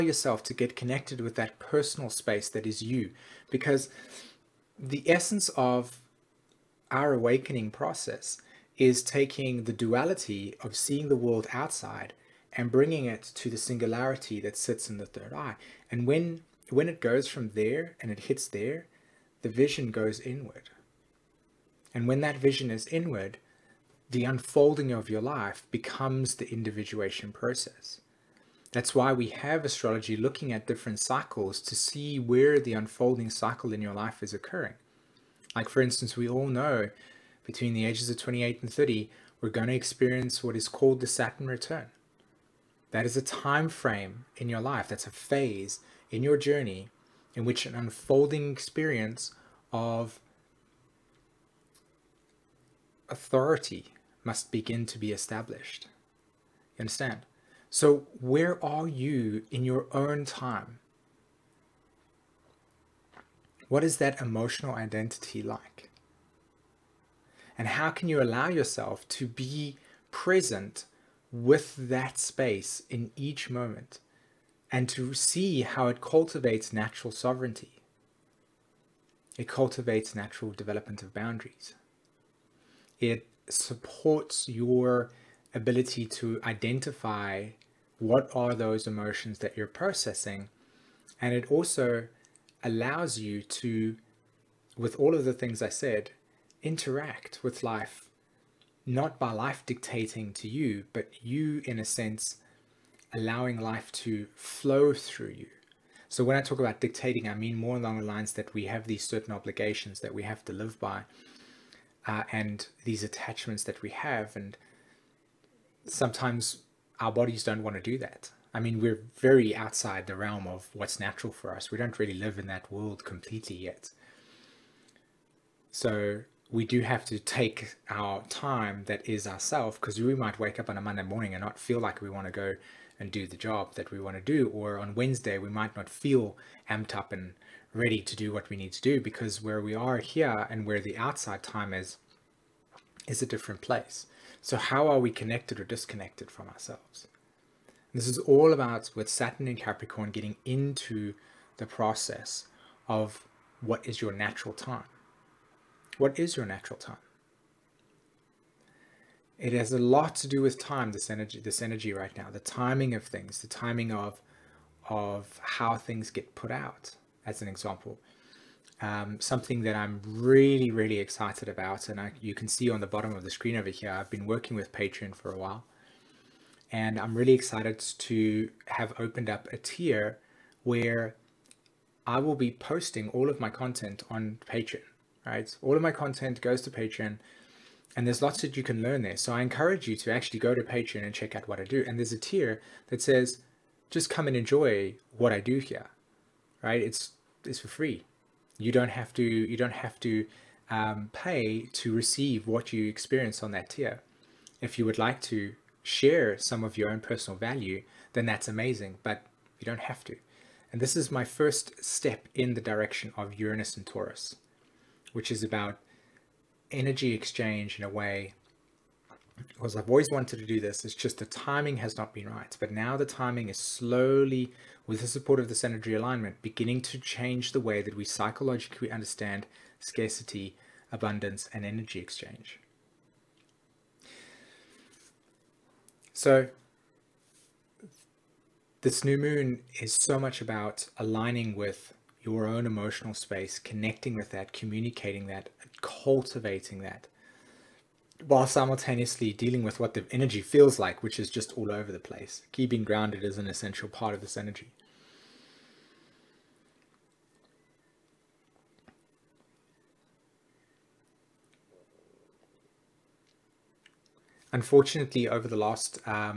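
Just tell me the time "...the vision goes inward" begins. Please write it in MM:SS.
00:19.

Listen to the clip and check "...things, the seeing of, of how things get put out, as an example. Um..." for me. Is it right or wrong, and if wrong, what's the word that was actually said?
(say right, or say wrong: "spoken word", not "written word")
wrong: "timing", not "seeing".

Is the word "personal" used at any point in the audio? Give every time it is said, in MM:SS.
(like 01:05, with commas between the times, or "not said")
00:01, 03:26.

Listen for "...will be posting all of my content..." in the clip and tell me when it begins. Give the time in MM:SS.
03:02.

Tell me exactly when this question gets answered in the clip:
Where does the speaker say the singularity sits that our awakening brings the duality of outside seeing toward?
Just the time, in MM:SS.
00:14.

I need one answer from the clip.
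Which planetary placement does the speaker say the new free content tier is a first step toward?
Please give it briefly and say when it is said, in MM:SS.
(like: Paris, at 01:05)
Uranus and Taurus, at 03:33.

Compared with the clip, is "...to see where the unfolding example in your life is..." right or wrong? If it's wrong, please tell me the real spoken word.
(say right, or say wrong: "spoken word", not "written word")
wrong: "cycle", not "example".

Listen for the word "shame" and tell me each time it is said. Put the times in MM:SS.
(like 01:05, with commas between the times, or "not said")
not said.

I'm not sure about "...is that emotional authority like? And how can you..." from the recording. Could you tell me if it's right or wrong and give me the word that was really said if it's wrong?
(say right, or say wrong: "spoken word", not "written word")
wrong: "identity", not "authority".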